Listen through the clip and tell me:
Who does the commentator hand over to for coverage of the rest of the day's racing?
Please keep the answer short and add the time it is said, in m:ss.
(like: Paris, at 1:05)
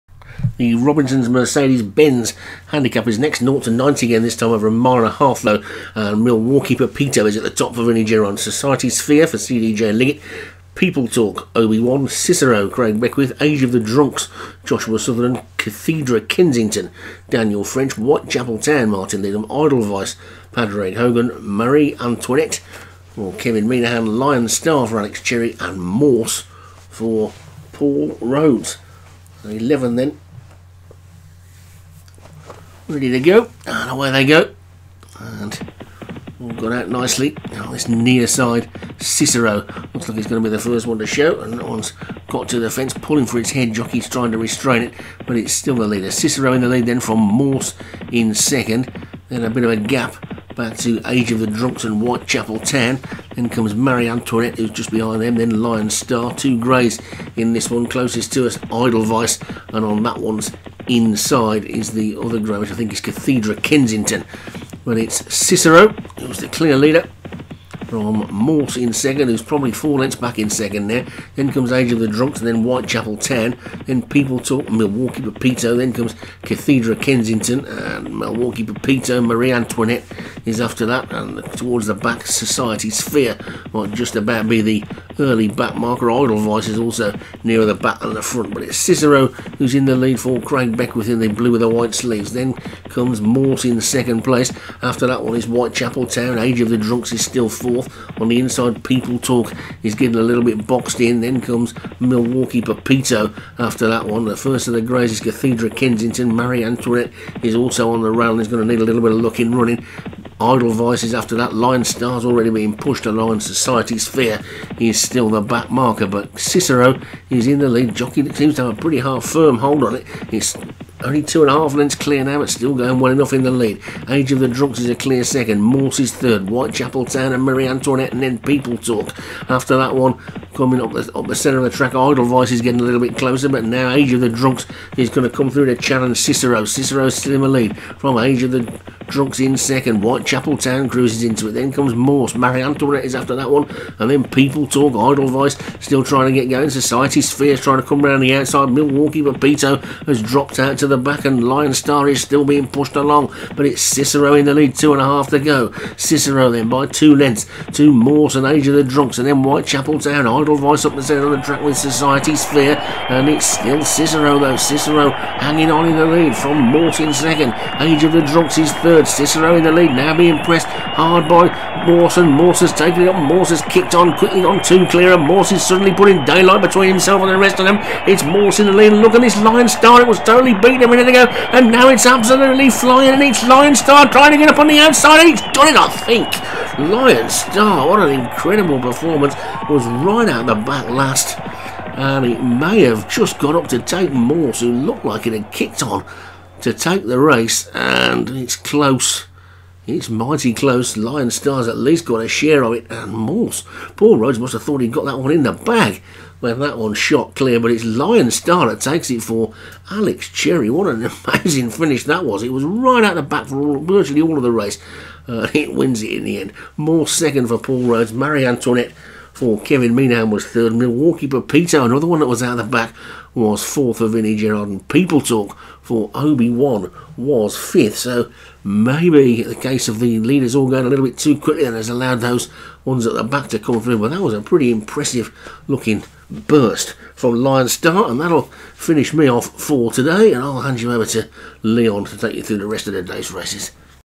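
Leon, at 4:01.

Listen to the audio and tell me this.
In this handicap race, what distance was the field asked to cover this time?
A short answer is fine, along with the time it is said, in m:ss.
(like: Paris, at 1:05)
A mile and a half, at 0:04.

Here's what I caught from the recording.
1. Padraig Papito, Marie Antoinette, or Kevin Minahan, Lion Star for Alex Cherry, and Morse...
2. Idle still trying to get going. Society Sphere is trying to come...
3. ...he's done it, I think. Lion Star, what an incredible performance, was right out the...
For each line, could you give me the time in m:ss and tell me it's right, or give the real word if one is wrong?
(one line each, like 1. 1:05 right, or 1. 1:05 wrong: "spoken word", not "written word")
1. 0:20 wrong: "Hogan", not "Papito"
2. 2:25 right
3. 3:05 right.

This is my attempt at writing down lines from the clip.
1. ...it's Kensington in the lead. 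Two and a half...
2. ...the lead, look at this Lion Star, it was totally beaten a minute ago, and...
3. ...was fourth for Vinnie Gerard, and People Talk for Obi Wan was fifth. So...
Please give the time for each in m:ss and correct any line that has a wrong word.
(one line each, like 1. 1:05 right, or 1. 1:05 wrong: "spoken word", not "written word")
1. 2:33 wrong: "Cicero", not "Kensington"
2. 2:58 right
3. 3:43 right.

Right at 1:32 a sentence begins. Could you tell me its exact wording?
Then comes Mort in second place.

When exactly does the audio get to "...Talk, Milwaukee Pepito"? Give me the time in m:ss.
1:14.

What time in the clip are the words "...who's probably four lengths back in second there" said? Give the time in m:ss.
1:09.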